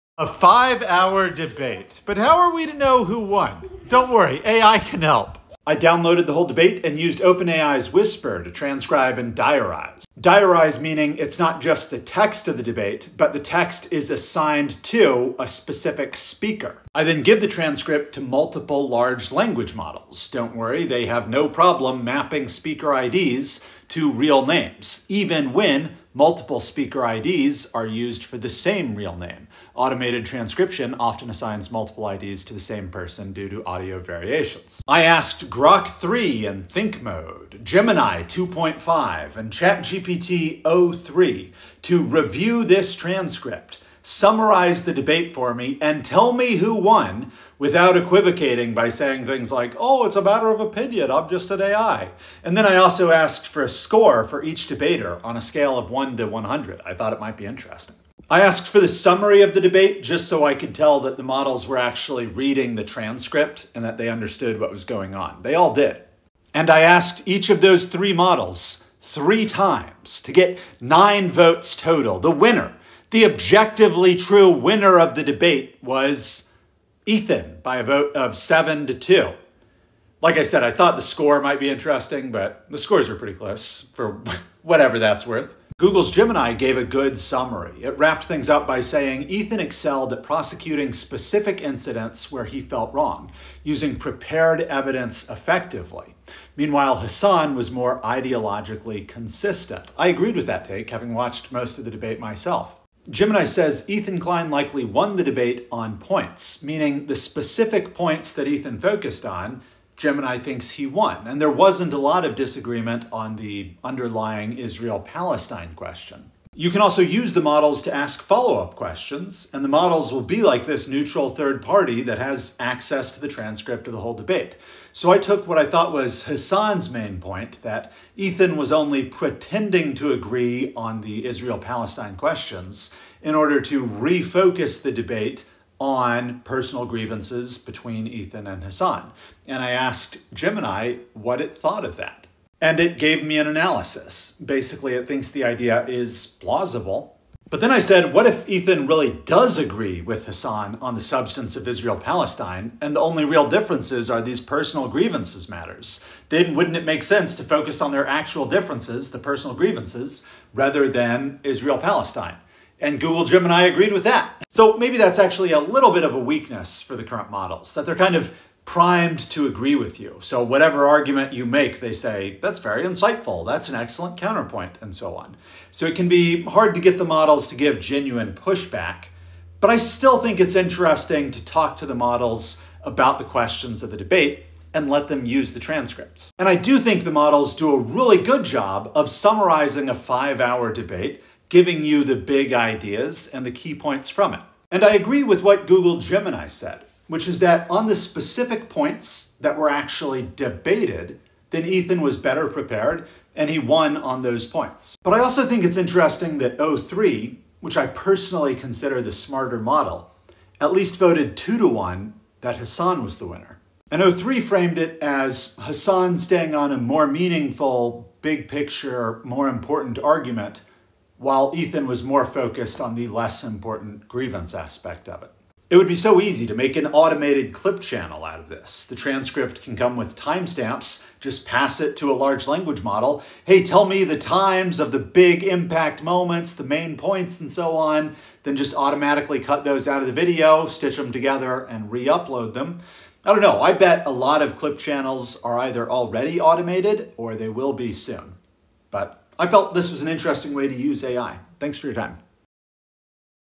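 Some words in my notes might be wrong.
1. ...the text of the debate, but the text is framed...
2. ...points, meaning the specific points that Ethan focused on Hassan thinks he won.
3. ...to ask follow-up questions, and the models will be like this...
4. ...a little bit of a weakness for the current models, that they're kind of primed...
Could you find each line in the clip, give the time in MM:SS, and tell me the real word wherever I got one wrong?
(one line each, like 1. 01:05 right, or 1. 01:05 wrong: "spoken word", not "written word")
1. 00:11 wrong: "assigned", not "framed"
2. 01:45 wrong: "Gemini", not "Hassan"
3. 01:57 right
4. 02:45 right.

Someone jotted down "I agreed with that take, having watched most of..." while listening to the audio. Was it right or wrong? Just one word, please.
right.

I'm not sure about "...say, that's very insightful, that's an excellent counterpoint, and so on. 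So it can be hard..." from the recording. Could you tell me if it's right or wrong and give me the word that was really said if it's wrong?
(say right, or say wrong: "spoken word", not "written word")
right.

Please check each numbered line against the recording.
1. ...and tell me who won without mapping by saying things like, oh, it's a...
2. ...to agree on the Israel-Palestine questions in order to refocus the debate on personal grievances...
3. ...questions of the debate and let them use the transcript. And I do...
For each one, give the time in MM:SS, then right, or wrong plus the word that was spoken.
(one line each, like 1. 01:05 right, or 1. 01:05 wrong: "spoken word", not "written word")
1. 00:45 wrong: "equivocating", not "mapping"
2. 02:09 right
3. 03:03 right.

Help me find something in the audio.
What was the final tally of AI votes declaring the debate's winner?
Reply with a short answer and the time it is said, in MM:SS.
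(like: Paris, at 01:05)
7 to 2, at 01:18.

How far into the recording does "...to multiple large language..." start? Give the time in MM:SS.
00:18.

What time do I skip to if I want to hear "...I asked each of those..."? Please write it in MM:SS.
01:06.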